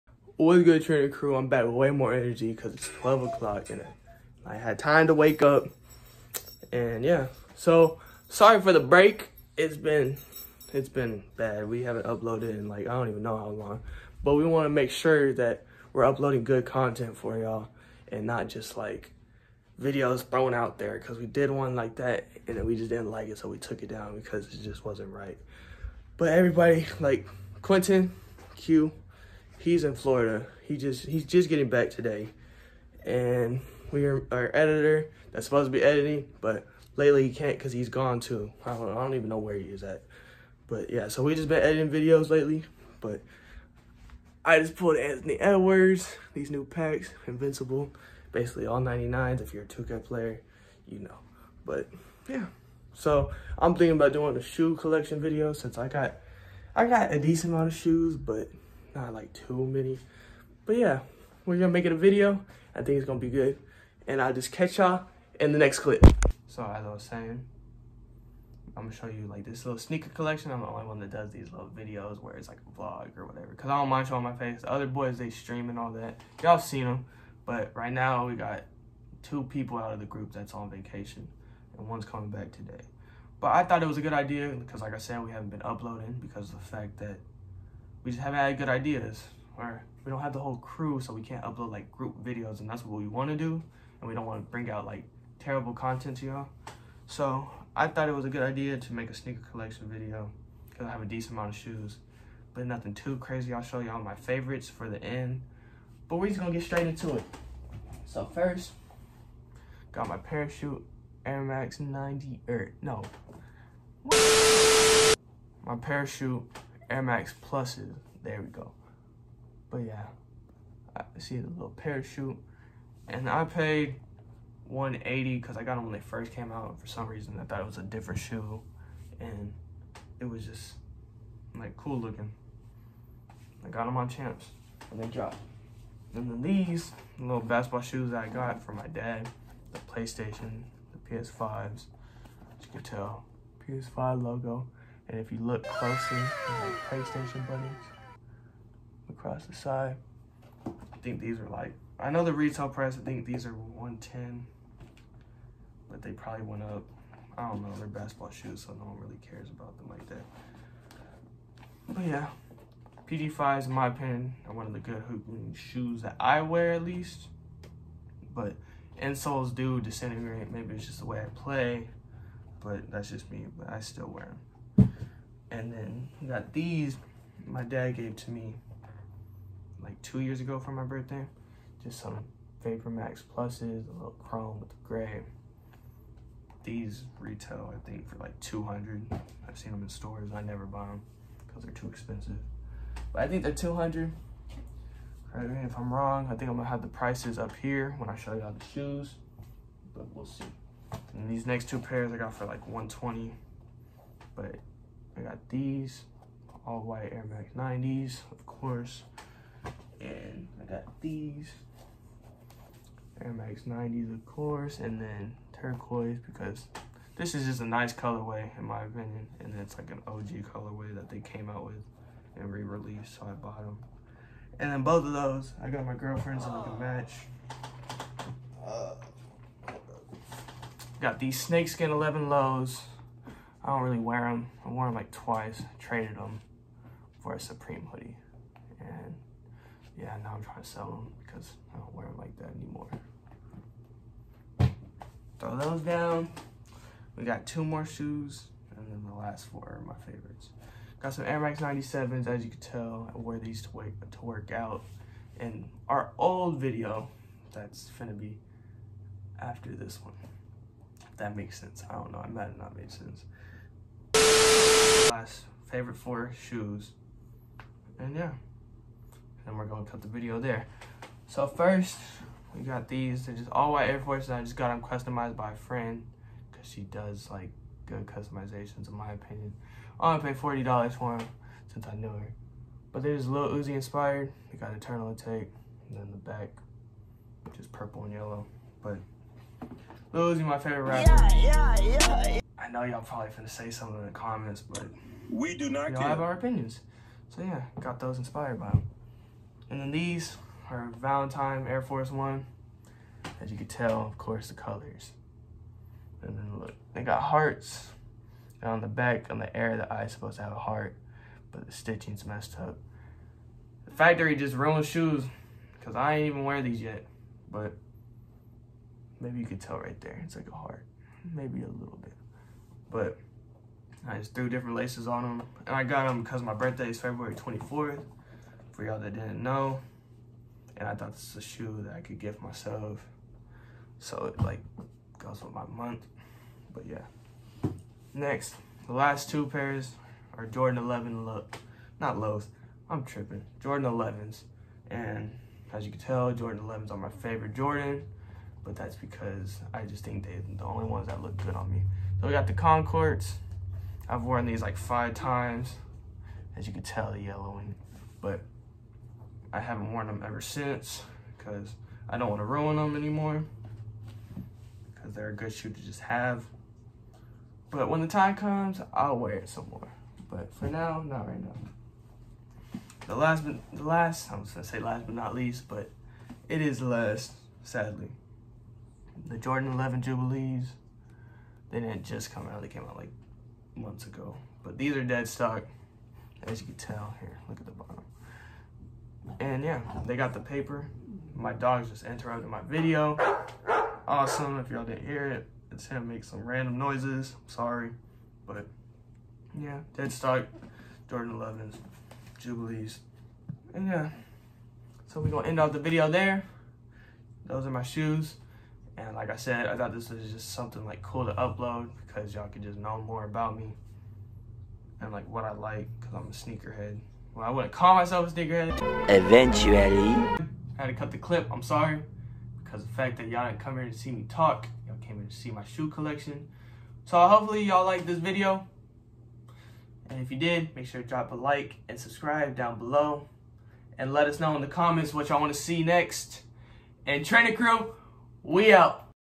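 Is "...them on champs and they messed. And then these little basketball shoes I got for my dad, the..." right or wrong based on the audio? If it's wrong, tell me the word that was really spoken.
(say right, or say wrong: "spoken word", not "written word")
wrong: "dropped", not "messed".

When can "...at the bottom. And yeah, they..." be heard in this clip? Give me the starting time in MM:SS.
06:27.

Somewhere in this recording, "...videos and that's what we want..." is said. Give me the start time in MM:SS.
01:32.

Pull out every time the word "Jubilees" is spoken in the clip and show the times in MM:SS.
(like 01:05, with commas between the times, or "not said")
06:20, 06:42.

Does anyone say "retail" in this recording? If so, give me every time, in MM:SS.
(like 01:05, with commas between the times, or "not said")
02:32, 03:07.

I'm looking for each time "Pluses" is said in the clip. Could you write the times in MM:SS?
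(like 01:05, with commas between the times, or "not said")
01:57, 03:03.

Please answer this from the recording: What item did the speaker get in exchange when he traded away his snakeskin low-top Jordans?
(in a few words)
Supreme hoodie.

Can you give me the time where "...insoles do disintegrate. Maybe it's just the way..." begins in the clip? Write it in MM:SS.
02:49.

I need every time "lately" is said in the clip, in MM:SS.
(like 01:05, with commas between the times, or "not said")
00:36, 00:42.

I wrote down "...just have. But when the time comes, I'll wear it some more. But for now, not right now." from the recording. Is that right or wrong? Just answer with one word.
right.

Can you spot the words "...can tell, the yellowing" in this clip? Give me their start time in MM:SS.
05:56.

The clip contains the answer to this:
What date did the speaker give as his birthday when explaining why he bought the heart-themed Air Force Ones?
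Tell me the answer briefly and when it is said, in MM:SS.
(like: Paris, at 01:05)
February 24th, at 05:26.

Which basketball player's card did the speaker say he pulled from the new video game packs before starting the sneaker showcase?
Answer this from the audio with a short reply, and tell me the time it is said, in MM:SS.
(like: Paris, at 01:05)
Anthony Edwards, at 00:44.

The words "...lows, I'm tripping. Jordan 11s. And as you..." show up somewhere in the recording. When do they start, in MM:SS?
05:42.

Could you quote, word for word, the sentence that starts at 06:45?
So we're gonna end off the video there.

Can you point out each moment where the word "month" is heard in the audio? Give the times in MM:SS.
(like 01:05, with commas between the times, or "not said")
05:35, 06:23.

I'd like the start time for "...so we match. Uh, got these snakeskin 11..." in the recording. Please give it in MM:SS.
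03:46.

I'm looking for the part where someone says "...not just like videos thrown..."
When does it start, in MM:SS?
00:18.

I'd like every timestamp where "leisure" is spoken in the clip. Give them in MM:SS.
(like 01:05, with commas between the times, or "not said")
not said.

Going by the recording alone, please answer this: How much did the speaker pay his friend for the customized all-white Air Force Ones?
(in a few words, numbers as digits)
$40.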